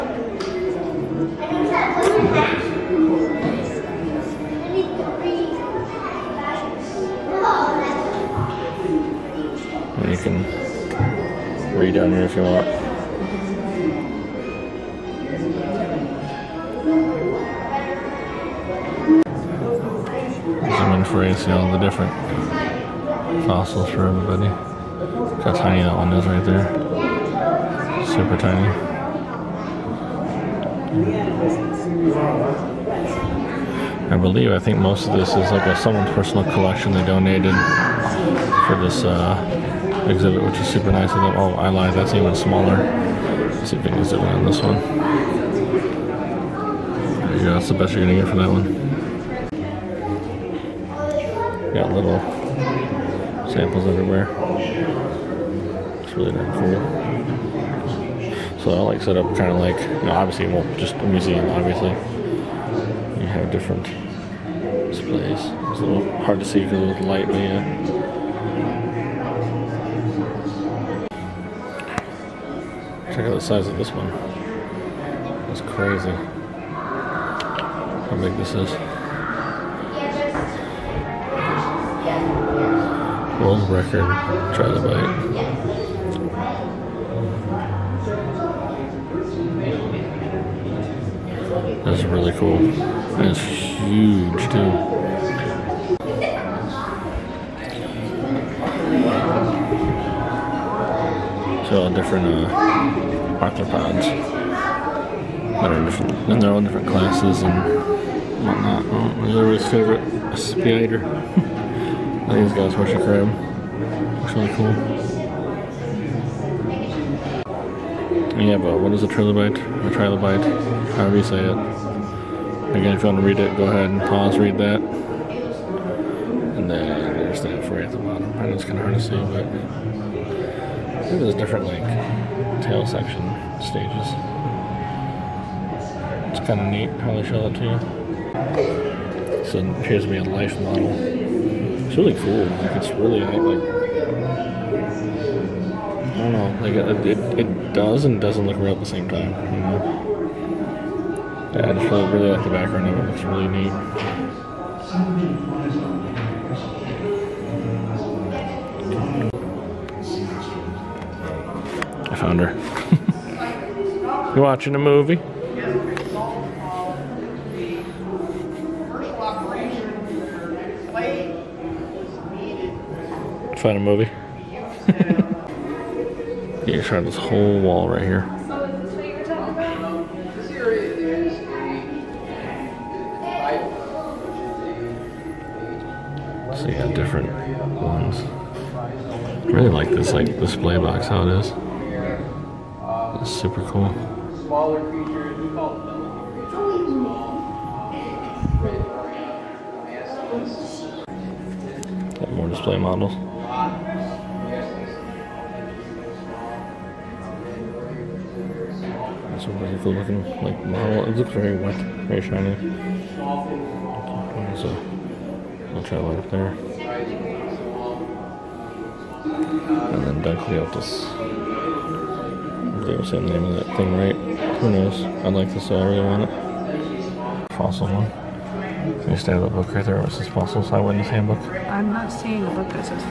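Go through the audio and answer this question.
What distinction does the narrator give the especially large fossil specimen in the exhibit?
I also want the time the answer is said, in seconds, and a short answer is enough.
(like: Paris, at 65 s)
World record trilobite, at 83 s.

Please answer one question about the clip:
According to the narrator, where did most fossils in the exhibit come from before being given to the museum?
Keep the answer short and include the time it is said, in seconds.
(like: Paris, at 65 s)
Someone's personal collection, at 35 s.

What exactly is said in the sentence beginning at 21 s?
for you see all the different fossils for everybody how tiny that one is right there.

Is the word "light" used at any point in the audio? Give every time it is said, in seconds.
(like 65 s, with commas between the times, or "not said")
67 s, 216 s.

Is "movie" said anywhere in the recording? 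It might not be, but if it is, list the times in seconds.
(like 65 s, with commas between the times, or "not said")
164 s, 173 s.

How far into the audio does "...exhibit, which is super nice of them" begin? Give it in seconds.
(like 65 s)
40 s.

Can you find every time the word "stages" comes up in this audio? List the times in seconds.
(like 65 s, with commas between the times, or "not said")
133 s.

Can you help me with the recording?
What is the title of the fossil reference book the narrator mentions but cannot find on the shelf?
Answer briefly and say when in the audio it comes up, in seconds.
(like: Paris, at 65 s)
Eyewitness handbook, at 230 s.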